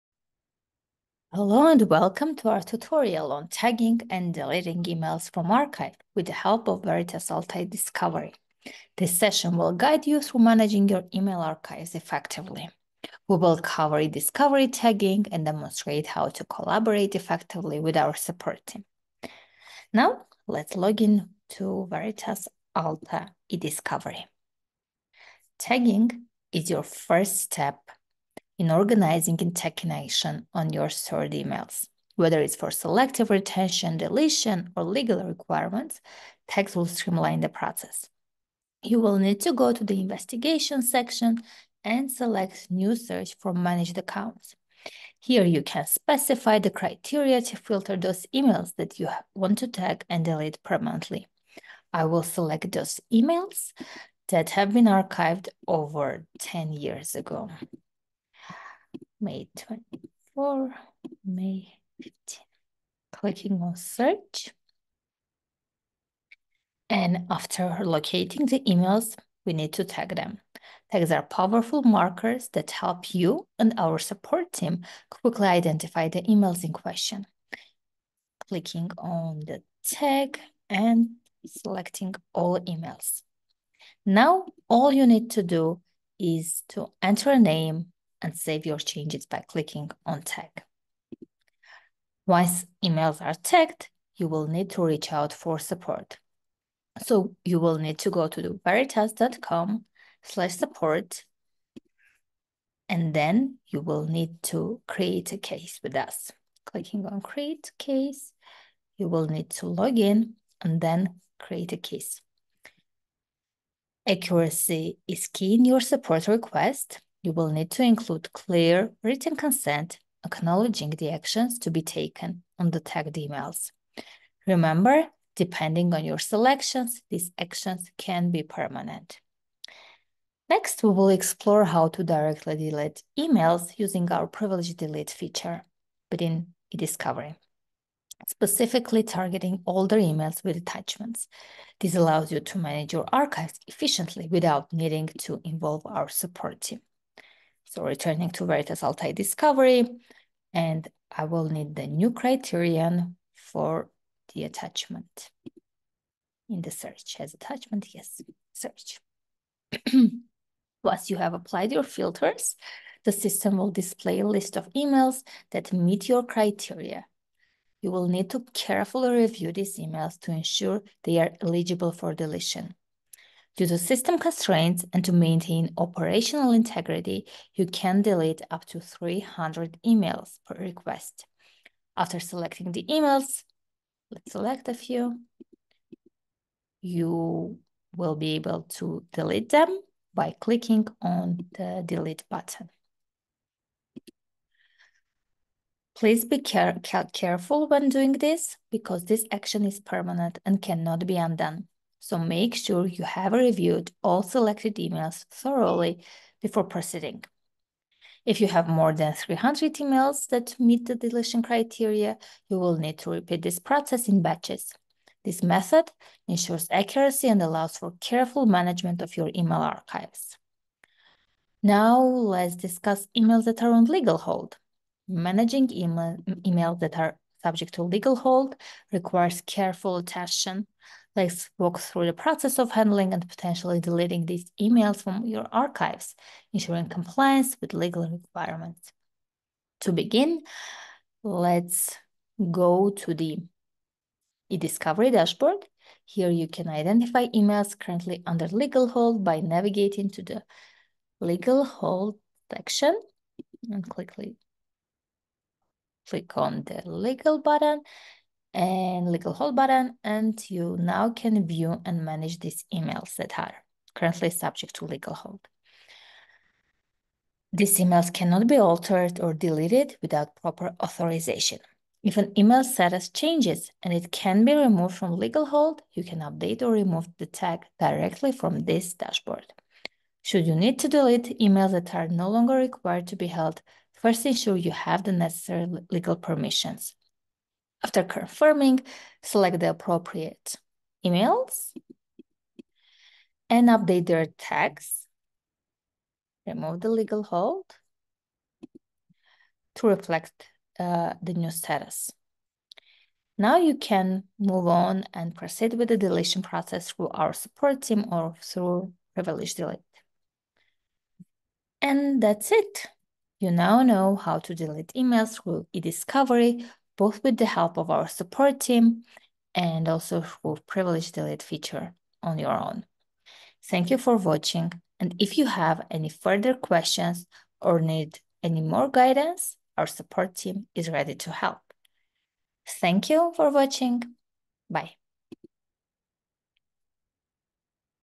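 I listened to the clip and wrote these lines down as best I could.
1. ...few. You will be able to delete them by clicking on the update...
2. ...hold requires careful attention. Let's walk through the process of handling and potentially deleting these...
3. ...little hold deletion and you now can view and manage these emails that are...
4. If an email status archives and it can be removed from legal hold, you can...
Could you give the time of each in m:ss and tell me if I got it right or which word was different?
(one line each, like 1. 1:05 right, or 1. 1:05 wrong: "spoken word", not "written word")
1. 3:04 wrong: "delete", not "update"
2. 3:48 right
3. 4:19 wrong: "button", not "deletion"
4. 4:32 wrong: "changes", not "archives".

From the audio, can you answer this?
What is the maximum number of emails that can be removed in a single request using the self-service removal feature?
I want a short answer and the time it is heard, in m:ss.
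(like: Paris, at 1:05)
300, at 2:58.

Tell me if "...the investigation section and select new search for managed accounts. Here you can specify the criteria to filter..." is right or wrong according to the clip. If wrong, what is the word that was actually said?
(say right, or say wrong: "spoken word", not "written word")
right.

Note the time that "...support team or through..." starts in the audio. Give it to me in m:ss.
5:07.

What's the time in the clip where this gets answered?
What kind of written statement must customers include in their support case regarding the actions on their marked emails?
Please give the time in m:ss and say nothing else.
1:58.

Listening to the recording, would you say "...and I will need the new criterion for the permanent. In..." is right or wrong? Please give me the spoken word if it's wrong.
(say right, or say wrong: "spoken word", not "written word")
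wrong: "attachment", not "permanent".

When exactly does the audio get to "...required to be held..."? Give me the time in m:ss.
4:42.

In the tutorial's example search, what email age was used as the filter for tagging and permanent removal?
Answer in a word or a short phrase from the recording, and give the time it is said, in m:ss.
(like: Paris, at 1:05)
over 10 years ago, at 0:55.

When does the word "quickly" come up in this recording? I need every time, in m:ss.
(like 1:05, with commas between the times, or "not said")
1:15, 4:13.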